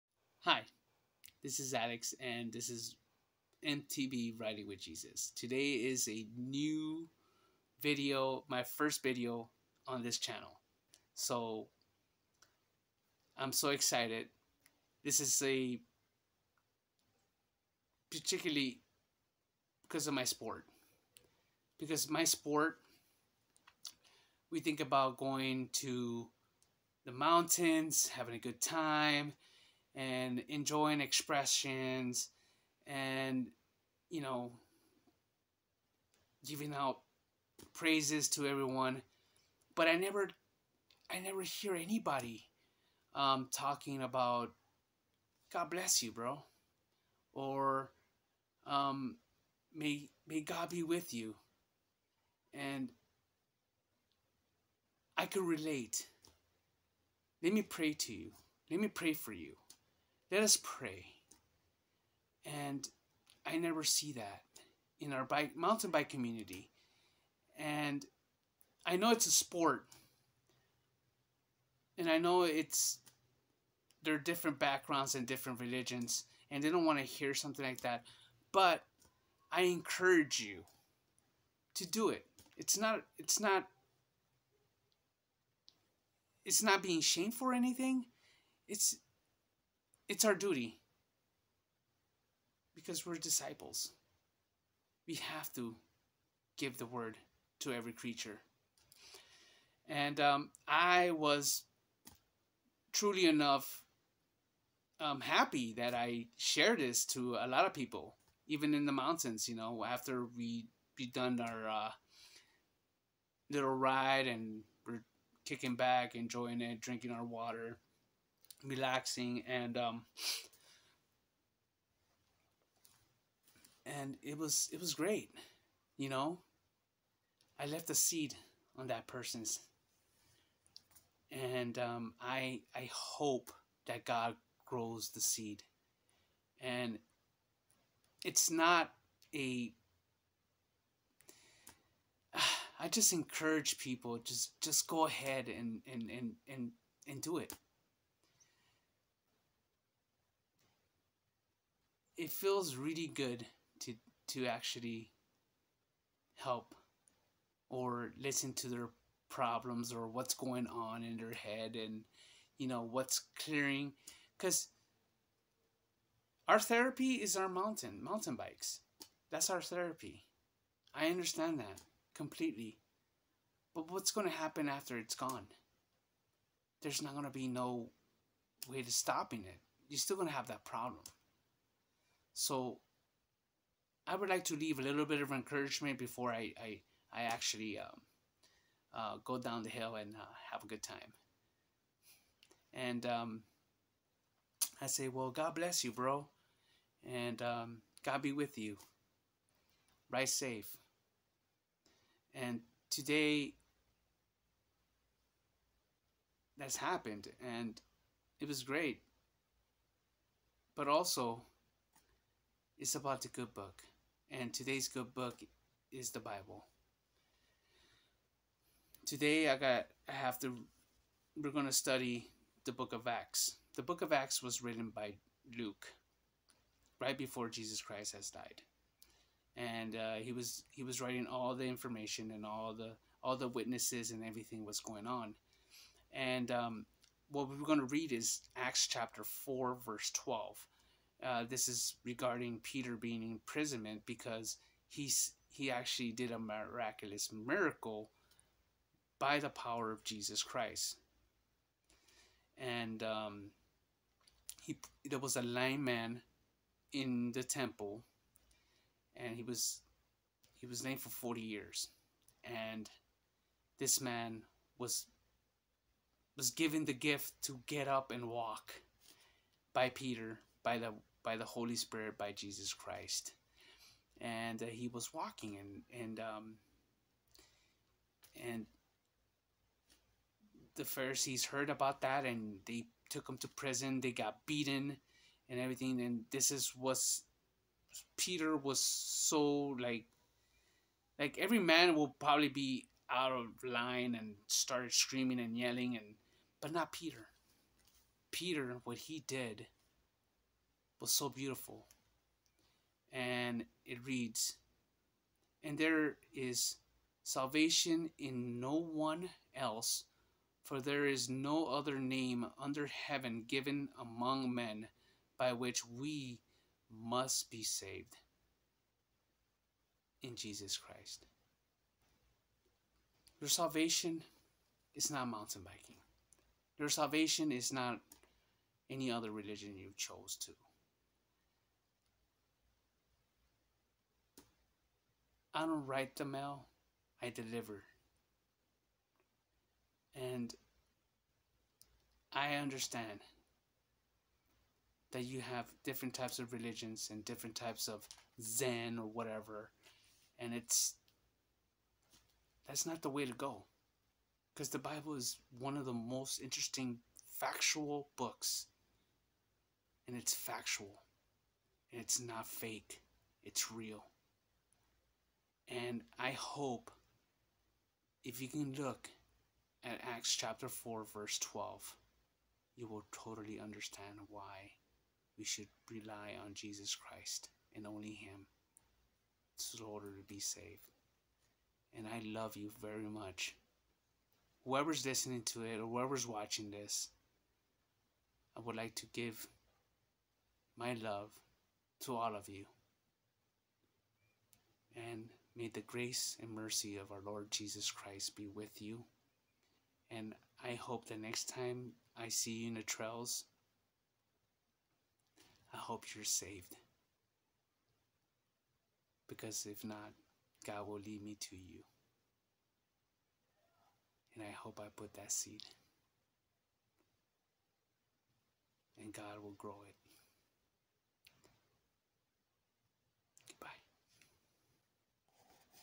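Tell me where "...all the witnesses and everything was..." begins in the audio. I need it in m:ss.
3:53.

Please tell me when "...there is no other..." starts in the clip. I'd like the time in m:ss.
5:10.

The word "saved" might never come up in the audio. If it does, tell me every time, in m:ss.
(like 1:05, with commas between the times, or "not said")
5:17, 6:20, 6:46.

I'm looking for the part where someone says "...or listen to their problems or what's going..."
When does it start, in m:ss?
2:37.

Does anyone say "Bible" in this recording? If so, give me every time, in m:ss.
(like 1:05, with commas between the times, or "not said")
3:36, 5:54.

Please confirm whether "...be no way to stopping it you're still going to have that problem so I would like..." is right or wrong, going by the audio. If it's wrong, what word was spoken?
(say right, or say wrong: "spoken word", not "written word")
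right.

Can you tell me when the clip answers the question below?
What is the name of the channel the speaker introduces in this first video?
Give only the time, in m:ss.
0:03.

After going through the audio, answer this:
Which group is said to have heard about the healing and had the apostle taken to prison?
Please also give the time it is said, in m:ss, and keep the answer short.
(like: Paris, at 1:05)
The Pharisees, at 4:40.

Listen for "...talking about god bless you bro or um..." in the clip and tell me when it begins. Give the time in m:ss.
0:43.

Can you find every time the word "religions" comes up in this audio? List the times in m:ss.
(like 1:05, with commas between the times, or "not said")
1:15, 5:29, 5:46.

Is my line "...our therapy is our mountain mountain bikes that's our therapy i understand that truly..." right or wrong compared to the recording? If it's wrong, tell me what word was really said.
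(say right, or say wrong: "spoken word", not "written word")
wrong: "completely", not "truly".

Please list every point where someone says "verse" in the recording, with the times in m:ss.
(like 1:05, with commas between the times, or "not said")
3:59, 6:11.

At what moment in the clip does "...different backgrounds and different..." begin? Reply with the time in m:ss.
1:14.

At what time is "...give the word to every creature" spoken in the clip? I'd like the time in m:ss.
1:36.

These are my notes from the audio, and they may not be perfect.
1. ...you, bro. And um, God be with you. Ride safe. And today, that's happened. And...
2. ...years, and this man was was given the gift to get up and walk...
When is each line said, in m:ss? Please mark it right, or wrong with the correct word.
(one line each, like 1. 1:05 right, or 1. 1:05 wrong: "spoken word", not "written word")
1. 3:15 right
2. 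4:21 right.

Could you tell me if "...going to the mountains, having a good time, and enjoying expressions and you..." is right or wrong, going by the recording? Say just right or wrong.
right.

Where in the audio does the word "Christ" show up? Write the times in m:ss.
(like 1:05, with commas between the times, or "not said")
3:47, 4:10, 4:32, 5:20, 6:16, 6:37.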